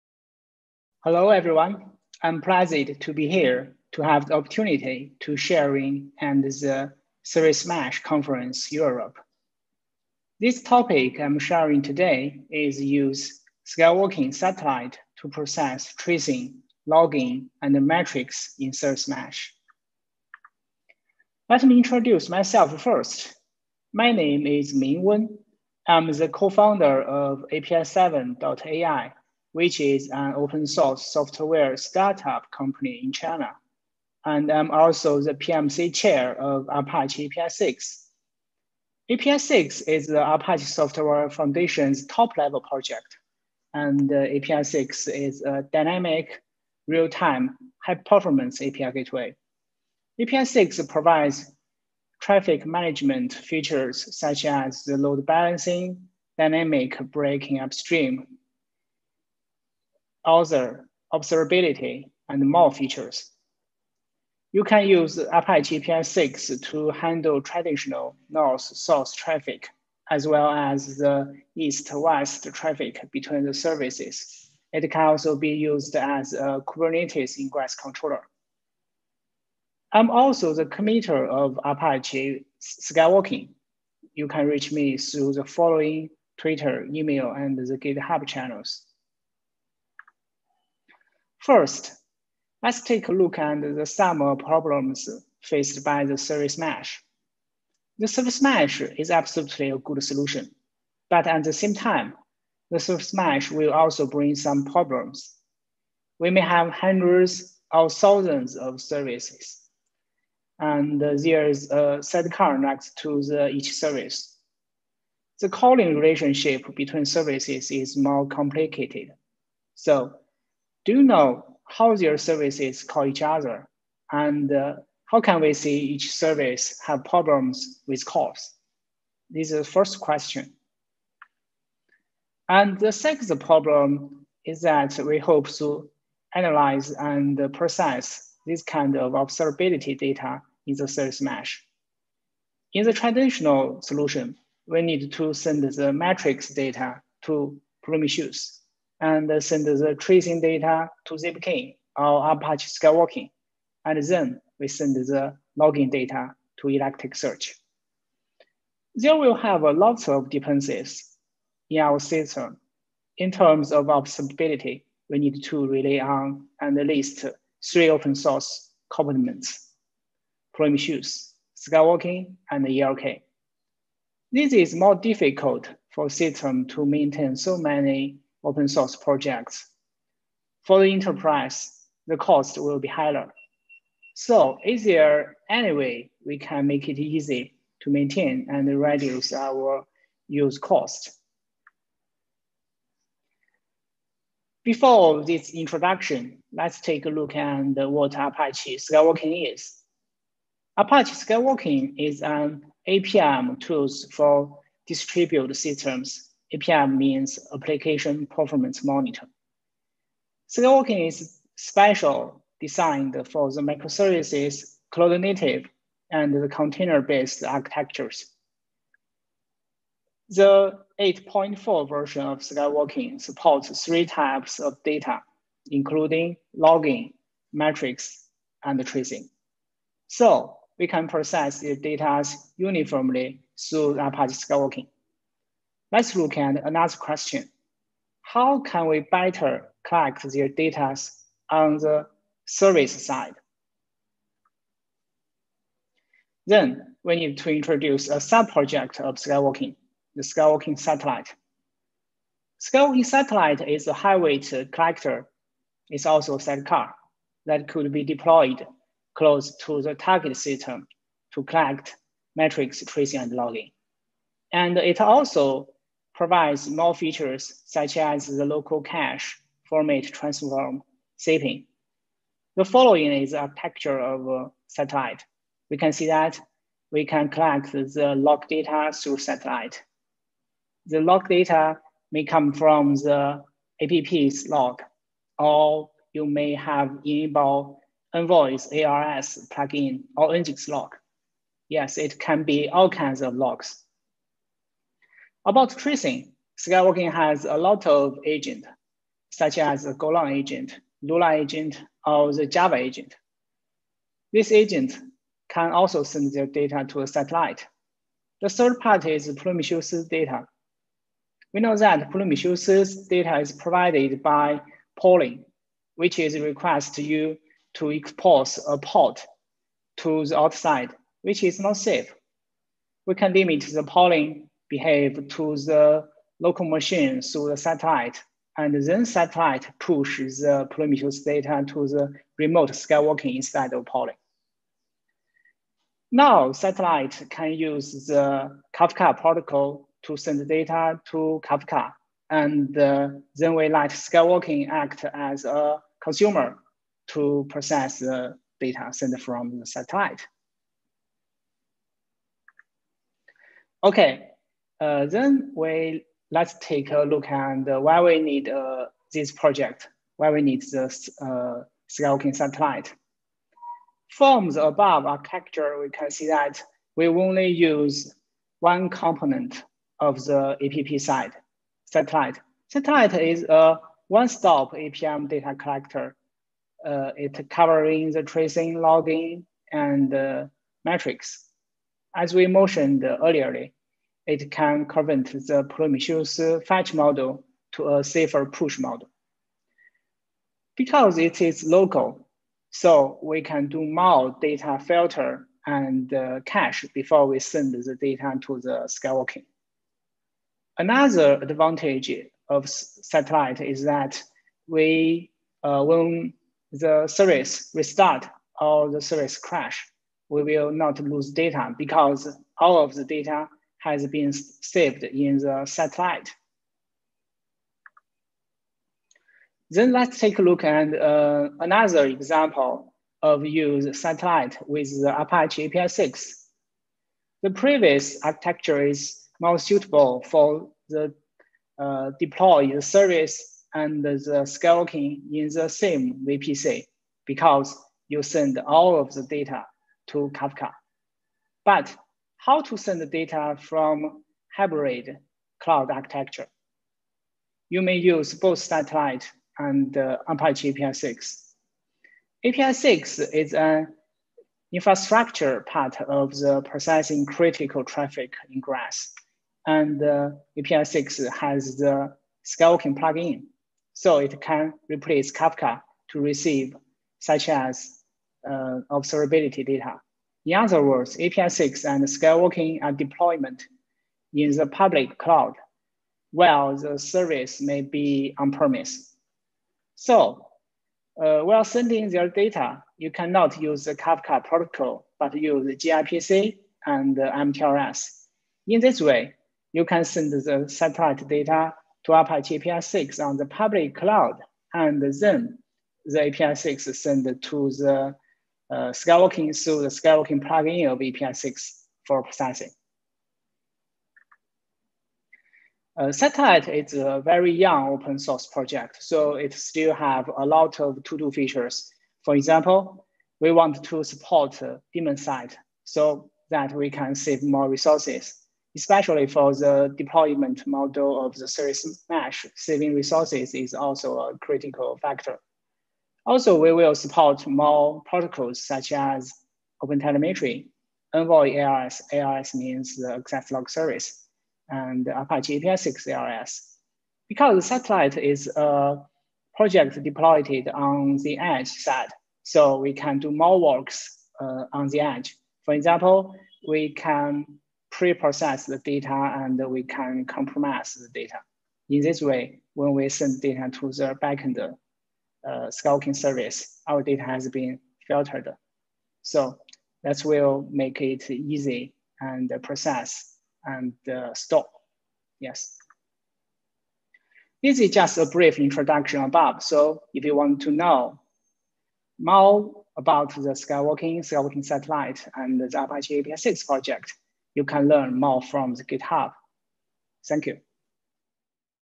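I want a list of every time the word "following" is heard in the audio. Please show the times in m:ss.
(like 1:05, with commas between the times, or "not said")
1:25, 4:32.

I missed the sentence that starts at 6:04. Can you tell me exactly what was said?
From the above architecture, we can see that we only use one component of the APP side, satellite.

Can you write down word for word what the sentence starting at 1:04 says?
You can use Apache APISIX to handle traditional north-south traffic, as well as the east-west traffic between the services.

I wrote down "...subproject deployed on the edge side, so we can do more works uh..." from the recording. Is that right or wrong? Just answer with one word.
wrong.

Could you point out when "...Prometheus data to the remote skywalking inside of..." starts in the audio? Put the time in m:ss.
5:30.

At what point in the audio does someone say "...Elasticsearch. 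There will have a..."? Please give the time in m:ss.
2:36.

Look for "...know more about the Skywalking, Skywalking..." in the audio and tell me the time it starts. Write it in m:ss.
9:30.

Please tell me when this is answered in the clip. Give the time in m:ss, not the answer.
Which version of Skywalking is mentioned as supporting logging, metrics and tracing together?
3:40.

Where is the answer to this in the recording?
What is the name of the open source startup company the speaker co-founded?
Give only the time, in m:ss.
0:27.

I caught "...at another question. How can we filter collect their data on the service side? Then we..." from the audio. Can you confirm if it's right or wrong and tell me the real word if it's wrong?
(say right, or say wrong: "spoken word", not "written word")
wrong: "better", not "filter".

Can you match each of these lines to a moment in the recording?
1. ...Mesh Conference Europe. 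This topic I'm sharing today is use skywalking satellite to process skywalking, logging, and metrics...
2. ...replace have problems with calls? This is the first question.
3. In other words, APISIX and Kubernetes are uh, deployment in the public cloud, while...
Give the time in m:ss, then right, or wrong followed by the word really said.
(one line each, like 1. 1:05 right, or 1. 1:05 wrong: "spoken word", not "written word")
1. 0:07 wrong: "tracing", not "skywalking"
2. 2:06 wrong: "service", not "replace"
3. 7:50 wrong: "Skywalking", not "Kubernetes".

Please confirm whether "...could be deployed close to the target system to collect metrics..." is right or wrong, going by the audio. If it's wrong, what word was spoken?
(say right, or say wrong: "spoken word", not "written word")
right.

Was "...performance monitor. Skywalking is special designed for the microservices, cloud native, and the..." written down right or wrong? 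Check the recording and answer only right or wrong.
right.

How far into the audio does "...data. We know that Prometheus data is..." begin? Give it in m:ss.
5:10.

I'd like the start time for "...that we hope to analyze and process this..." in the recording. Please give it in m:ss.
2:14.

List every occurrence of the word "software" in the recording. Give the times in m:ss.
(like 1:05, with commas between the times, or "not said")
0:31, 0:40.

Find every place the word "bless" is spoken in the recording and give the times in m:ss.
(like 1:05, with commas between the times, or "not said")
not said.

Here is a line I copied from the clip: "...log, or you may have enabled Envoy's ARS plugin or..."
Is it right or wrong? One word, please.
right.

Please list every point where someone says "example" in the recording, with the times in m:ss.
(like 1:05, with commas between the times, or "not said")
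7:02, 8:32, 9:05.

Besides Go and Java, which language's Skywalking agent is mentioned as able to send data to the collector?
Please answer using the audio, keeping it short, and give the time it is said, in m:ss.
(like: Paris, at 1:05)
Lua, at 5:01.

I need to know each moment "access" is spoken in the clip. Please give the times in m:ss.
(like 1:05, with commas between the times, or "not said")
8:53.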